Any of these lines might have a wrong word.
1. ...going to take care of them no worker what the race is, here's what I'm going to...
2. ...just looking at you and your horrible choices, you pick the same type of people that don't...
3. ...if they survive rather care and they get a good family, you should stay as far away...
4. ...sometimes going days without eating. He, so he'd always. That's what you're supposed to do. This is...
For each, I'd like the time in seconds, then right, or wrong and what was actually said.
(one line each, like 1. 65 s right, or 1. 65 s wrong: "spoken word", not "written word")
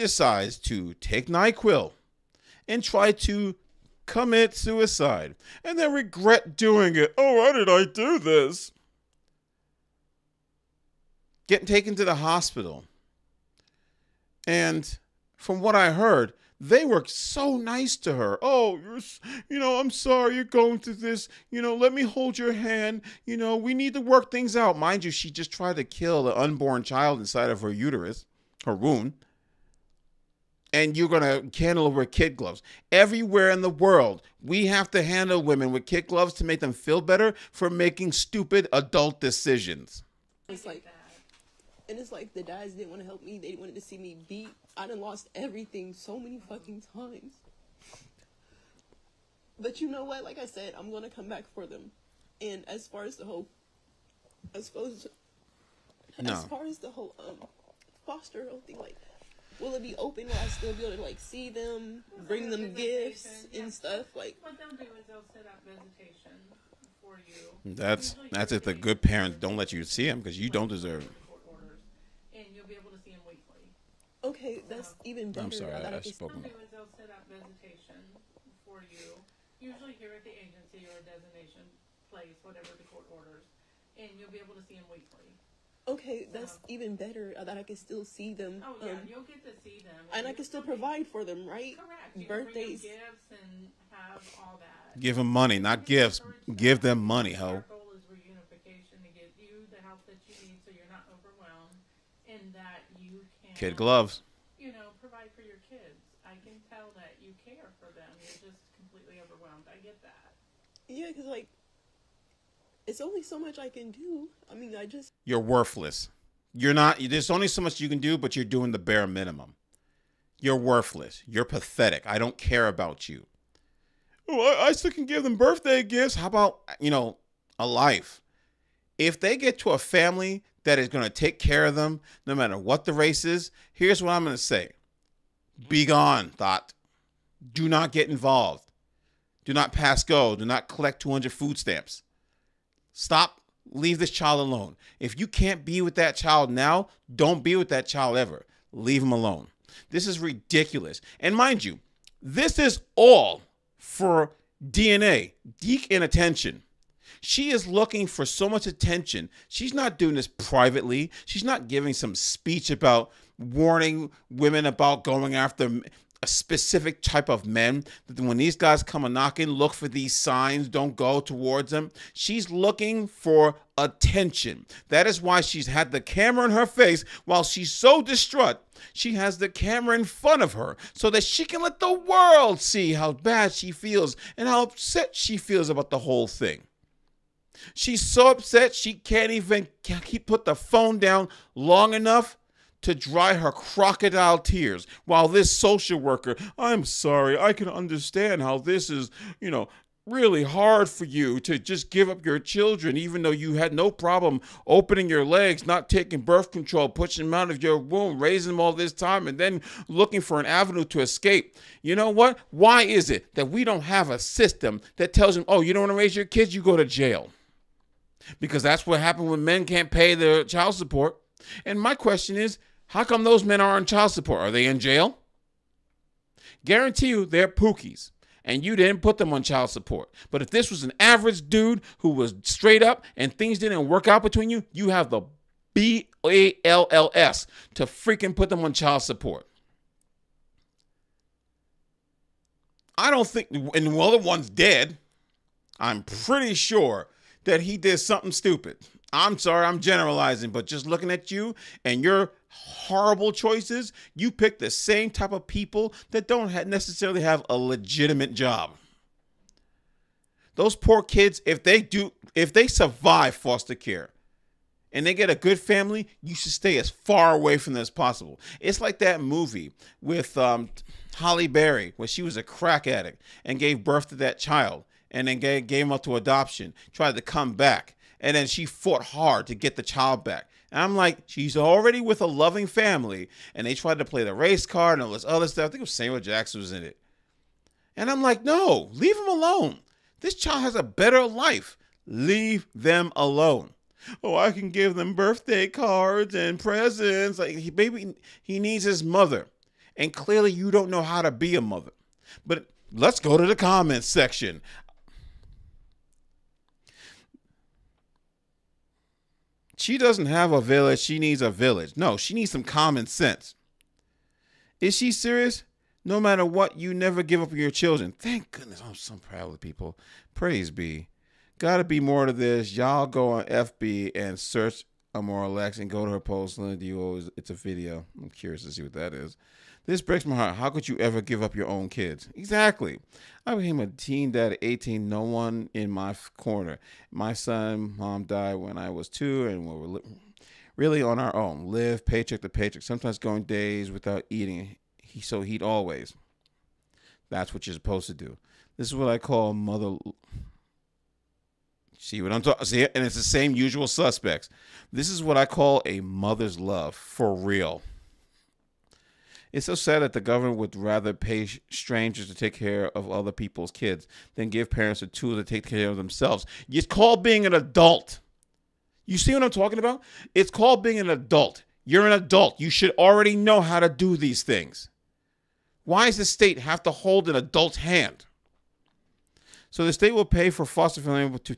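1. 130 s wrong: "matter", not "worker"
2. 250 s right
3. 262 s wrong: "foster", not "rather"
4. 342 s right.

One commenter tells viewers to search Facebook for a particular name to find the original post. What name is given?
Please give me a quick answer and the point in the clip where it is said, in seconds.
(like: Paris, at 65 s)
Amora Lex, at 325 s.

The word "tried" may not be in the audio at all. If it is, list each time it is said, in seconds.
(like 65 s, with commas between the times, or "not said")
25 s, 276 s, 283 s.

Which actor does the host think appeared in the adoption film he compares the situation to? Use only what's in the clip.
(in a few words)
Samuel Jackson.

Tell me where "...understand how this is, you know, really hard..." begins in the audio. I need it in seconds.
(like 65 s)
197 s.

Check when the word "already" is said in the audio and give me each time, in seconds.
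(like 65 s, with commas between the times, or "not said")
281 s, 372 s.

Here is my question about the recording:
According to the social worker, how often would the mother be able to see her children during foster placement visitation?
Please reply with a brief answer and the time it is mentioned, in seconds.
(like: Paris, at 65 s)
weekly, at 84 s.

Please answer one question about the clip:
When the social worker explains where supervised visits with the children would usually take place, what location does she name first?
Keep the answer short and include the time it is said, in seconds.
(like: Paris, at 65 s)
the agency, at 80 s.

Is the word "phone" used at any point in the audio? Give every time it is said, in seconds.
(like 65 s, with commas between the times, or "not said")
190 s.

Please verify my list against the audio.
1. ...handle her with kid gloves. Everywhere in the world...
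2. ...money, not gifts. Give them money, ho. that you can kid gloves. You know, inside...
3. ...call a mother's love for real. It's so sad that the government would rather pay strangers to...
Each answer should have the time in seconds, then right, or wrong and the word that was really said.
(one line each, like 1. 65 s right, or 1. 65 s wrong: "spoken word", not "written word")
1. 31 s right
2. 95 s wrong: "provide", not "inside"
3. 355 s right.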